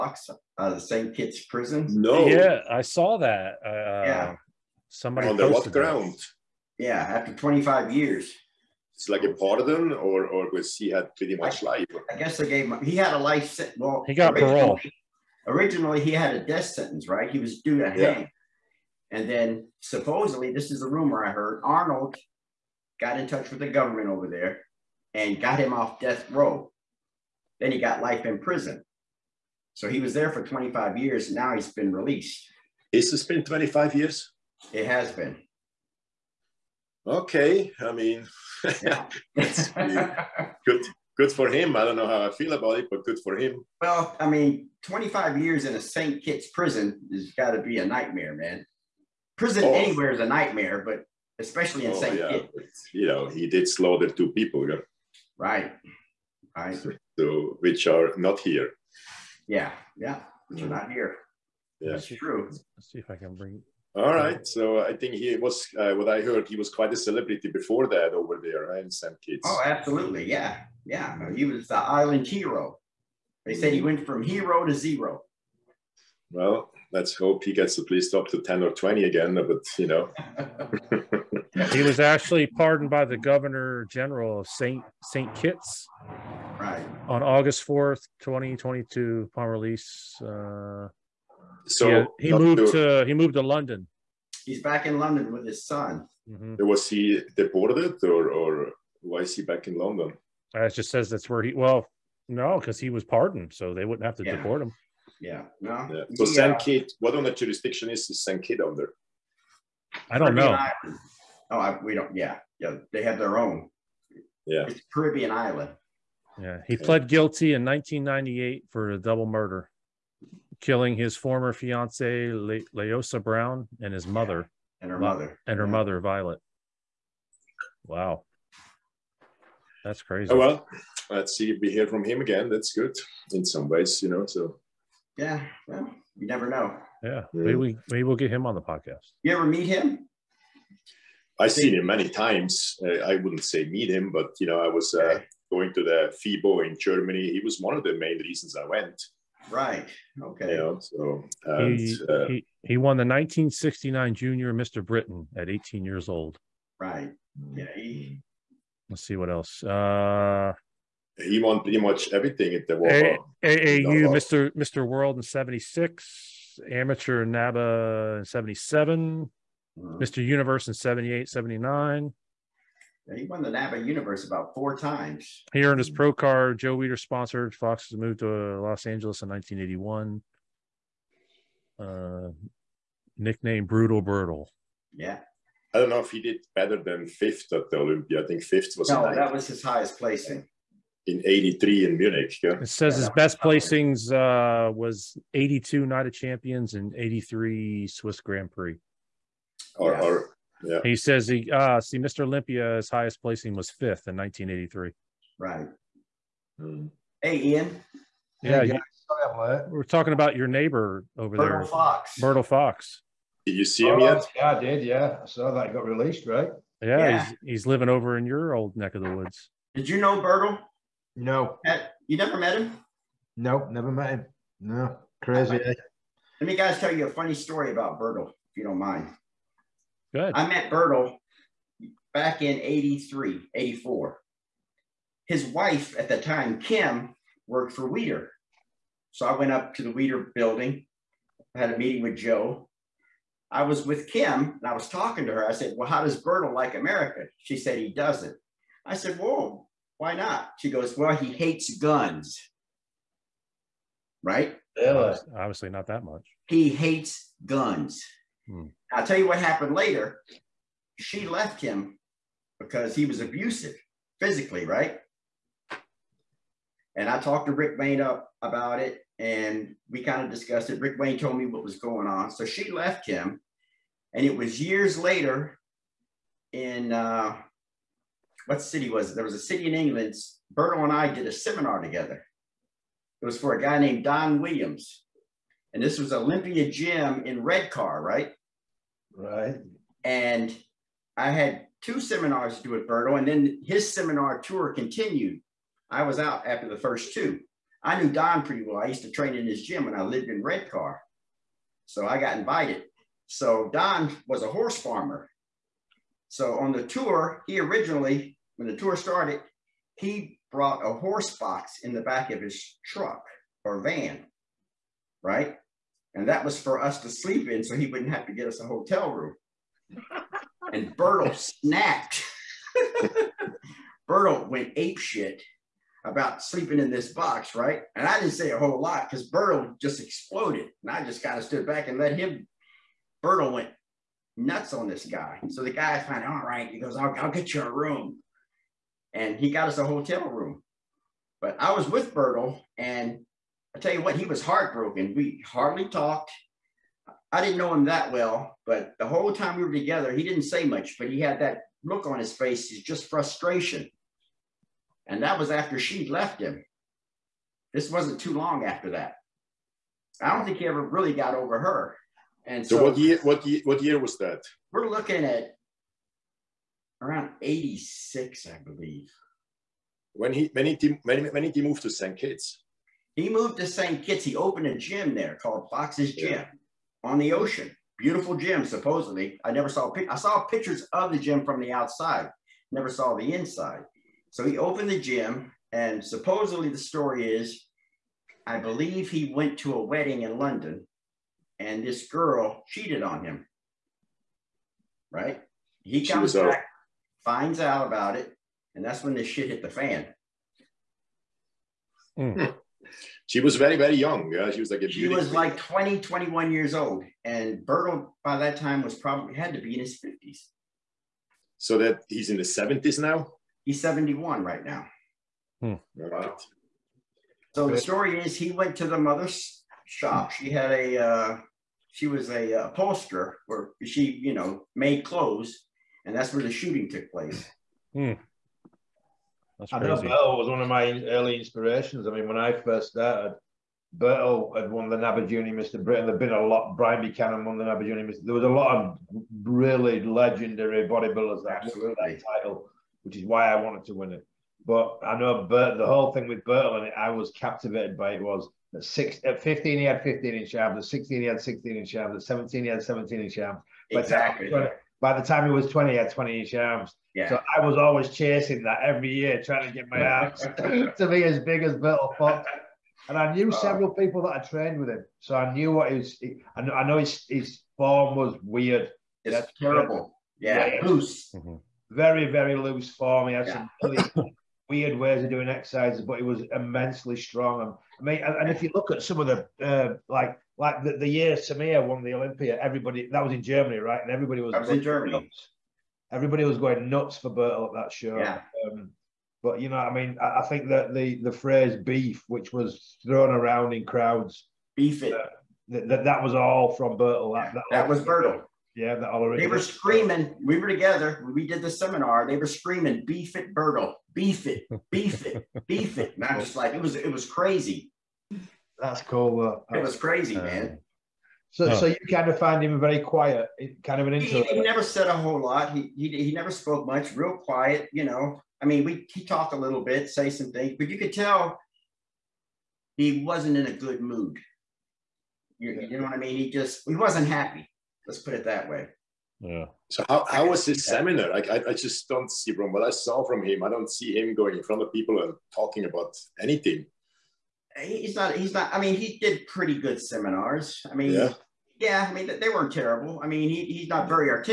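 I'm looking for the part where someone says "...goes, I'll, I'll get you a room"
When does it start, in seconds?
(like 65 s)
336 s.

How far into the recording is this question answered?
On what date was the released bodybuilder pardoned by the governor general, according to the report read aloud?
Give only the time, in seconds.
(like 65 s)
87 s.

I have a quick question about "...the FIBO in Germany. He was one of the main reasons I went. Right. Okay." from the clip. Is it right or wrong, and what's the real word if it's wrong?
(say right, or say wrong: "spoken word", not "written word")
right.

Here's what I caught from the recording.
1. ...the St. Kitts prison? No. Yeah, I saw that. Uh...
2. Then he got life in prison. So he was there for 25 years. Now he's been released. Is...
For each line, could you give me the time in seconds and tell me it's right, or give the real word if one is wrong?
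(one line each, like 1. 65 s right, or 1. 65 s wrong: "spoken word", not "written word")
1. 0 s right
2. 27 s right.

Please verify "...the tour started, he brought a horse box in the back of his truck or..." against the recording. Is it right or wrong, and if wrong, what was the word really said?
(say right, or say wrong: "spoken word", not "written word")
right.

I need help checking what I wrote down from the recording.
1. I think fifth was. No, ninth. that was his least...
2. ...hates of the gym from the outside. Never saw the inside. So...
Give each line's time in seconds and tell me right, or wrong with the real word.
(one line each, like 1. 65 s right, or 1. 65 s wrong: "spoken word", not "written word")
1. 188 s wrong: "highest", not "least"
2. 380 s wrong: "pictures", not "hates".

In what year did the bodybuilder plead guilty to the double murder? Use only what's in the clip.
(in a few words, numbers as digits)
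1998.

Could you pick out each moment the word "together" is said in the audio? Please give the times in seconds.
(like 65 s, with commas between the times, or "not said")
281 s, 349 s, 500 s.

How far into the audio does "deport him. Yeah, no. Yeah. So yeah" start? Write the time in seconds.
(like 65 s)
104 s.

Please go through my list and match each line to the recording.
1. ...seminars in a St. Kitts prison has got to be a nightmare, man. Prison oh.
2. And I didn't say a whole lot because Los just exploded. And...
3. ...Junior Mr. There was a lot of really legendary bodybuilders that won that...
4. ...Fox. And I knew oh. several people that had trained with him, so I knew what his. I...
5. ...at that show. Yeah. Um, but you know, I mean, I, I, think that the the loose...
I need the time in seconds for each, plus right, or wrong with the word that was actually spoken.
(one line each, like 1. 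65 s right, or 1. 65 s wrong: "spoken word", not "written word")
1. 45 s wrong: "years", not "seminars"
2. 327 s wrong: "Bertil", not "Los"
3. 437 s right
4. 462 s right
5. 487 s wrong: "phrase", not "loose".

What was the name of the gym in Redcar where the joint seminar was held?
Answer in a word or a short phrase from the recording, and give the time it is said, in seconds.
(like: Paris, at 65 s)
Olympia Gym, at 286 s.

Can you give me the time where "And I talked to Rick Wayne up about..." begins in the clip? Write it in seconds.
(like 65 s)
266 s.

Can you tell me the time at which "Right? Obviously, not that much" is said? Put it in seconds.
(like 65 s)
254 s.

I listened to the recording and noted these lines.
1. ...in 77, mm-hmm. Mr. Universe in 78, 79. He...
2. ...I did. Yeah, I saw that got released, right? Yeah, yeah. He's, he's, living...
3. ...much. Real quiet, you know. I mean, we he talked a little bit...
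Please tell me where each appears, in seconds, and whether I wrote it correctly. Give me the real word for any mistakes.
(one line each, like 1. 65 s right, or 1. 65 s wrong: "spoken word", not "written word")
1. 168 s right
2. 214 s right
3. 516 s right.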